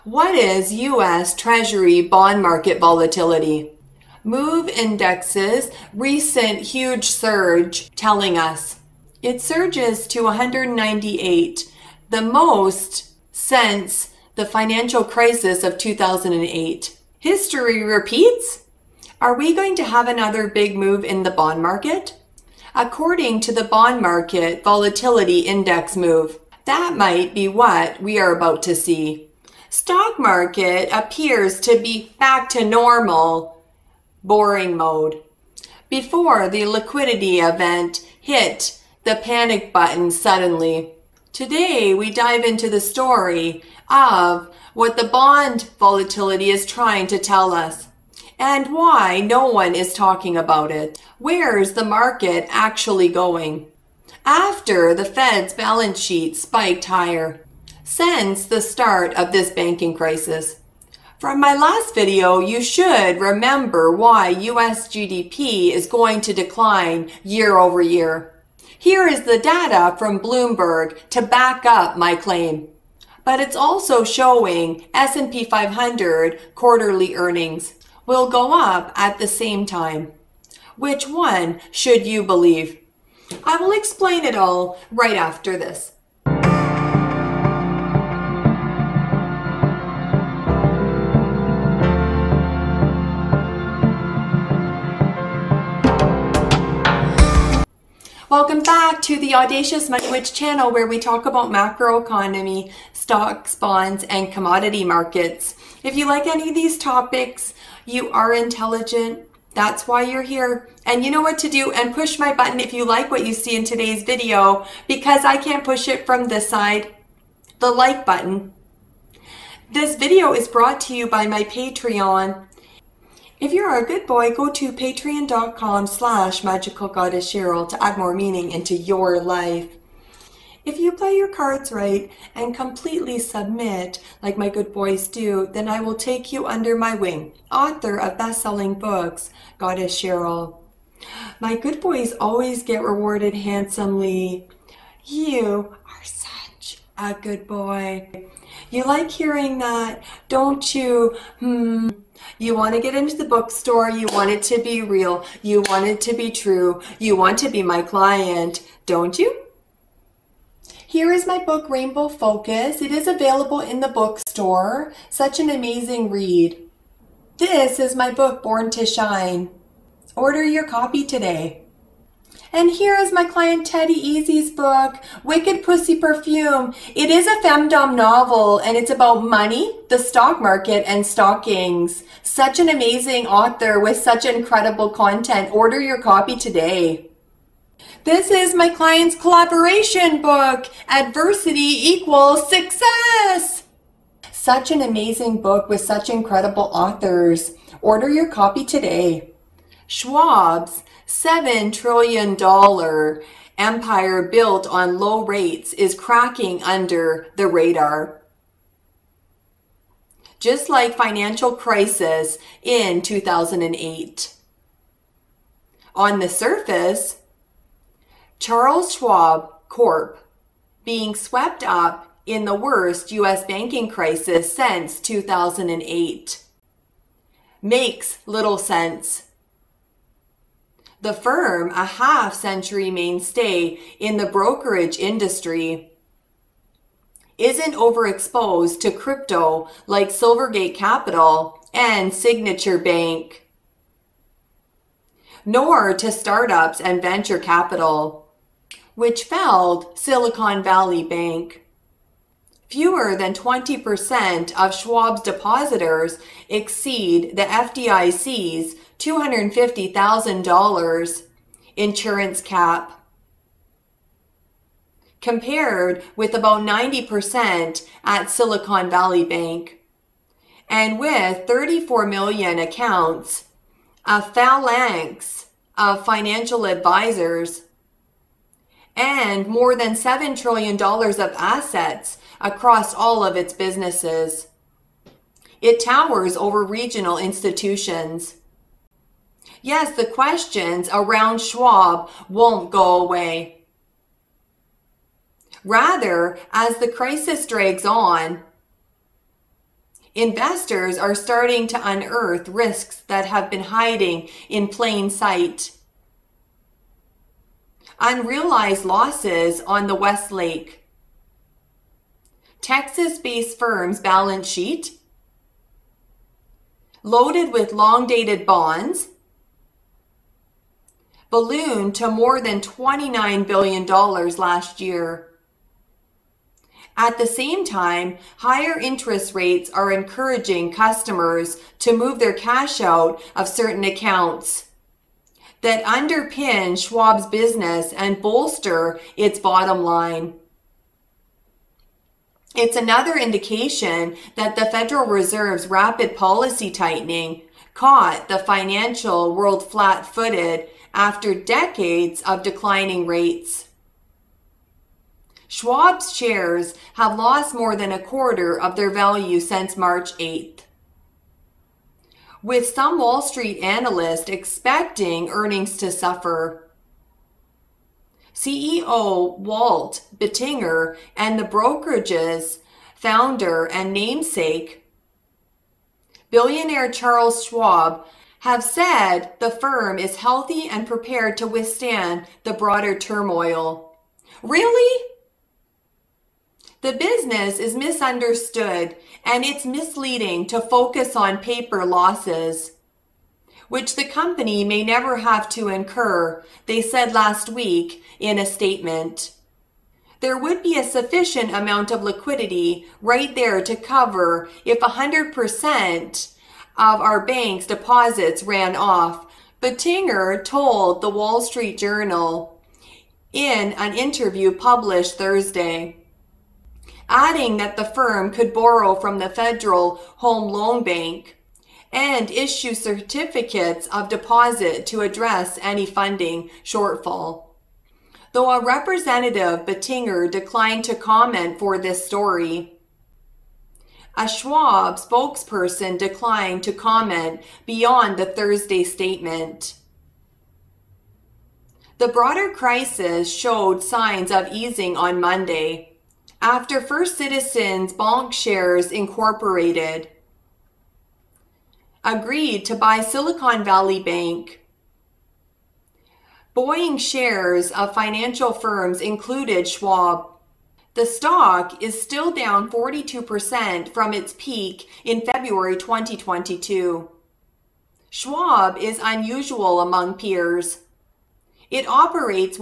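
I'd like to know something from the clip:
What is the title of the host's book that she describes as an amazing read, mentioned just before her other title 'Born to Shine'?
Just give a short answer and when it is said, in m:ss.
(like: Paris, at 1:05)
Rainbow Focus, at 2:41.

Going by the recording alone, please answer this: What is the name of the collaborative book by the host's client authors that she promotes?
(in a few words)
Adversity Equals Success.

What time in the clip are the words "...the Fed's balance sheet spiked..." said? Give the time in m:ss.
0:54.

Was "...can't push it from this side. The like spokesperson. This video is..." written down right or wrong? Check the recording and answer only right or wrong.
wrong.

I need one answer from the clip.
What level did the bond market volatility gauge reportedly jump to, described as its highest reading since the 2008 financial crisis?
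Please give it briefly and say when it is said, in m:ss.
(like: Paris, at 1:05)
198, at 0:10.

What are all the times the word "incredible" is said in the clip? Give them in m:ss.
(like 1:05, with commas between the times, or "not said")
3:04, 3:16.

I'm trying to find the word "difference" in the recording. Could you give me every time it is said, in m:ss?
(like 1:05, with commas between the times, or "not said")
not said.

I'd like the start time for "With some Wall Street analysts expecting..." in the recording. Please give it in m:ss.
6:02.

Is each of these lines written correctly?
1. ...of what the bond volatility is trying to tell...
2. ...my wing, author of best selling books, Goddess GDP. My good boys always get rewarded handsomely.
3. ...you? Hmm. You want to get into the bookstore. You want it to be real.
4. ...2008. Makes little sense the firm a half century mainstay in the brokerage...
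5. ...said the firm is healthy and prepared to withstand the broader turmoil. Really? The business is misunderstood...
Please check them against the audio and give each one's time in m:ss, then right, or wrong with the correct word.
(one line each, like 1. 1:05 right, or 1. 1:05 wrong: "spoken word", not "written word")
1. 0:43 right
2. 2:16 wrong: "Cheryl", not "GDP"
3. 2:30 right
4. 3:44 right
5. 6:18 right.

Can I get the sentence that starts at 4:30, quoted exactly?
And with 34 million accounts, a phalanx of financial advisors, and more than $7 trillion of assets across all of its businesses.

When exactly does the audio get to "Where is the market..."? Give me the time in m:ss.
0:51.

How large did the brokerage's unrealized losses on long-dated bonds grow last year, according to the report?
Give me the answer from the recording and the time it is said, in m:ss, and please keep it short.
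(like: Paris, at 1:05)
More than $29 billion, at 5:22.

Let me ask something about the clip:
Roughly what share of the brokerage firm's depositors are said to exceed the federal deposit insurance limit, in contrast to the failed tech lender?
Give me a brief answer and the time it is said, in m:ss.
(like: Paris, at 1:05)
Fewer than 20%, at 4:12.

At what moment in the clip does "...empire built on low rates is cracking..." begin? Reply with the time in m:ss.
3:23.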